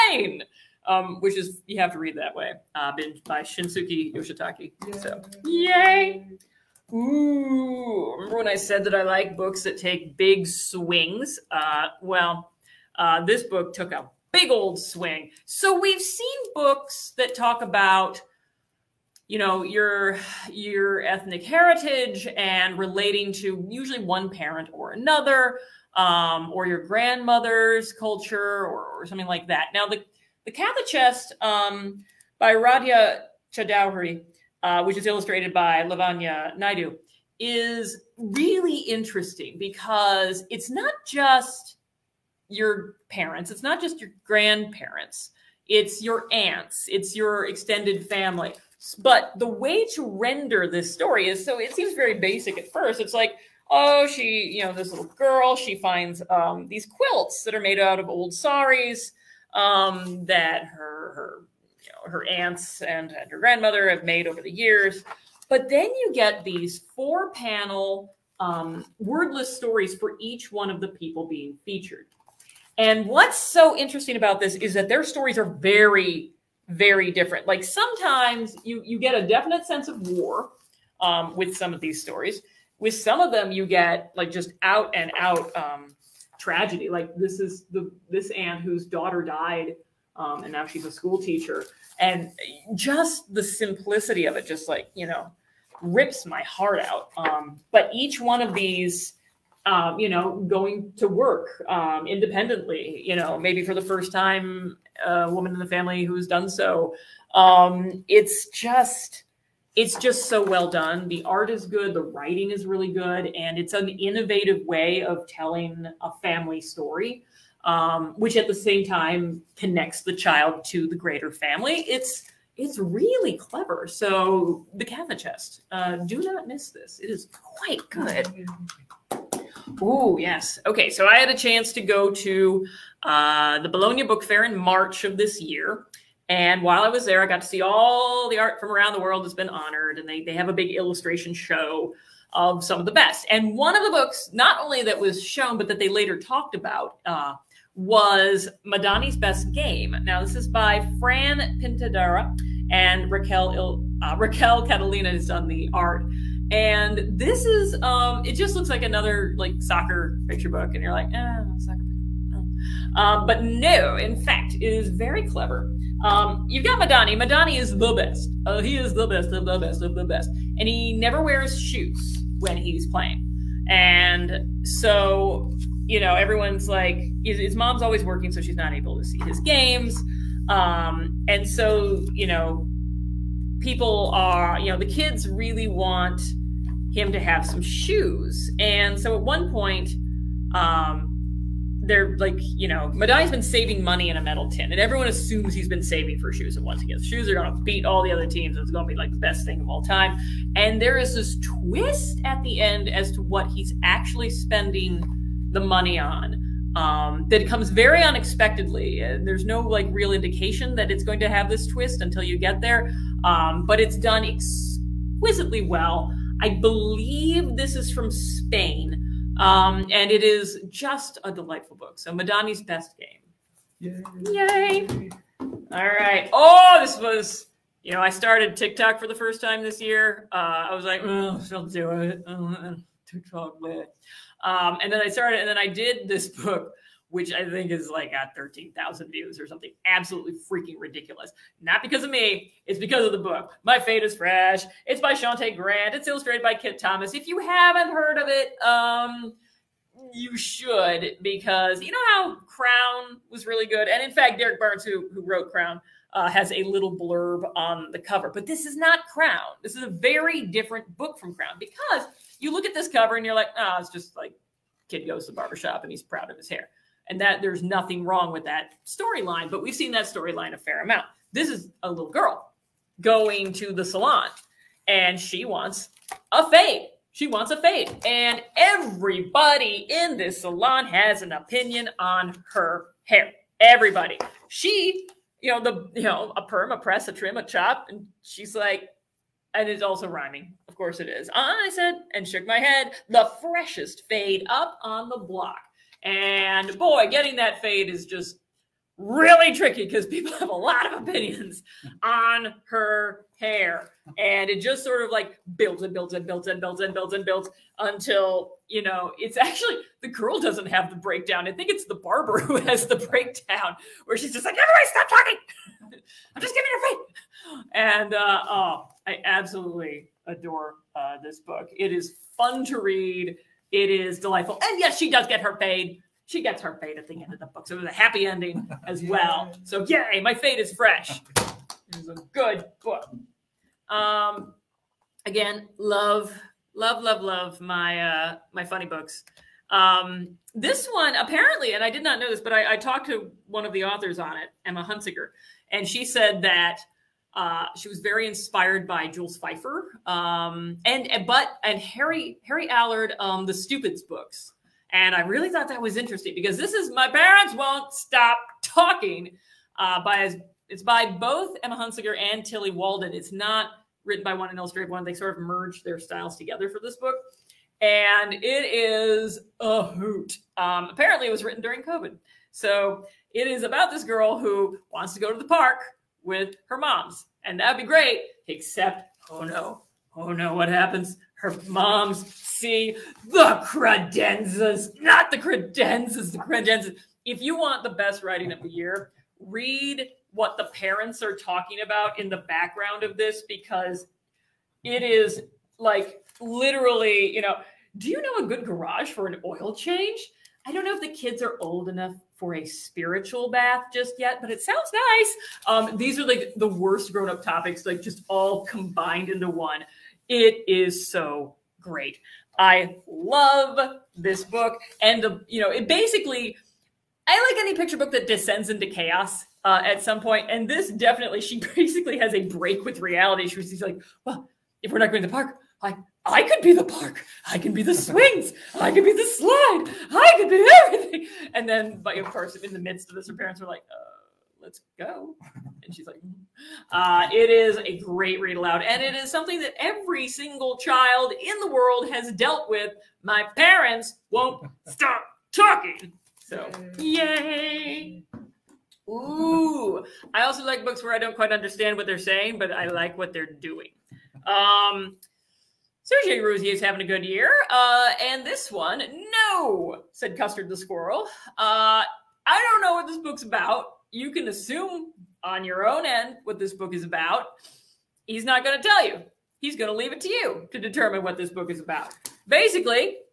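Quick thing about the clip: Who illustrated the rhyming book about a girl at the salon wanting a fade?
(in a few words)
Kitt Thomas.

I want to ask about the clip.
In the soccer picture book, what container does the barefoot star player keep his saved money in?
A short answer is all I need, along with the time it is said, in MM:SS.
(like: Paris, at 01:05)
A metal tin, at 03:14.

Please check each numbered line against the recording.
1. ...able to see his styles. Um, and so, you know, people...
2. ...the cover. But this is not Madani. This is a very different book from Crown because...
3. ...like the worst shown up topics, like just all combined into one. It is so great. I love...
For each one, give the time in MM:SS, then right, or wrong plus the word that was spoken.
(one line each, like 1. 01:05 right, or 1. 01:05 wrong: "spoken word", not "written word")
1. 02:58 wrong: "games", not "styles"
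2. 04:17 wrong: "Crown", not "Madani"
3. 06:46 wrong: "grown", not "shown".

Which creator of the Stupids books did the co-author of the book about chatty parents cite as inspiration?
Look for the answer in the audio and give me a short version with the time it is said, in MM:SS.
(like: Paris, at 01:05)
Harry Allard, at 05:52.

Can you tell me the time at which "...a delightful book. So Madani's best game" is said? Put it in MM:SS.
03:41.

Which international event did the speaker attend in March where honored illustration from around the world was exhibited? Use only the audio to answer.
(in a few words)
Bologna Book Fair.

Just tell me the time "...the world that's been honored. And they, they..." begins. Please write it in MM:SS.
02:18.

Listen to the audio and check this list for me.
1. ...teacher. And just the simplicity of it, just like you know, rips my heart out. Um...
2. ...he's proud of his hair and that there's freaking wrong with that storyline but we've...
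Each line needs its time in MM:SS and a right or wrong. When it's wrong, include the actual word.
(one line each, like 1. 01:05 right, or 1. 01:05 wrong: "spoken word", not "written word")
1. 01:31 right
2. 04:25 wrong: "nothing", not "freaking".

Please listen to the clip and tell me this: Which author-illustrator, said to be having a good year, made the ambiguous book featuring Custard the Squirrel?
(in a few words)
Sergio Ruzzier.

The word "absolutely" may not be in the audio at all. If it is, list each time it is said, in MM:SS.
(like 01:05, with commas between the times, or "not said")
03:59, 05:19.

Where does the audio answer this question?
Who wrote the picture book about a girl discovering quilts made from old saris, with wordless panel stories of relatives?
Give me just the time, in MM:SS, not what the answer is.
00:32.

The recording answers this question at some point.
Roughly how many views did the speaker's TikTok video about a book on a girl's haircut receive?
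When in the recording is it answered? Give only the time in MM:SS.
03:58.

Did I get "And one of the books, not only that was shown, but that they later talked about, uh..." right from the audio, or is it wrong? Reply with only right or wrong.
right.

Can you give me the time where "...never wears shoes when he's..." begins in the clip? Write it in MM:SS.
02:50.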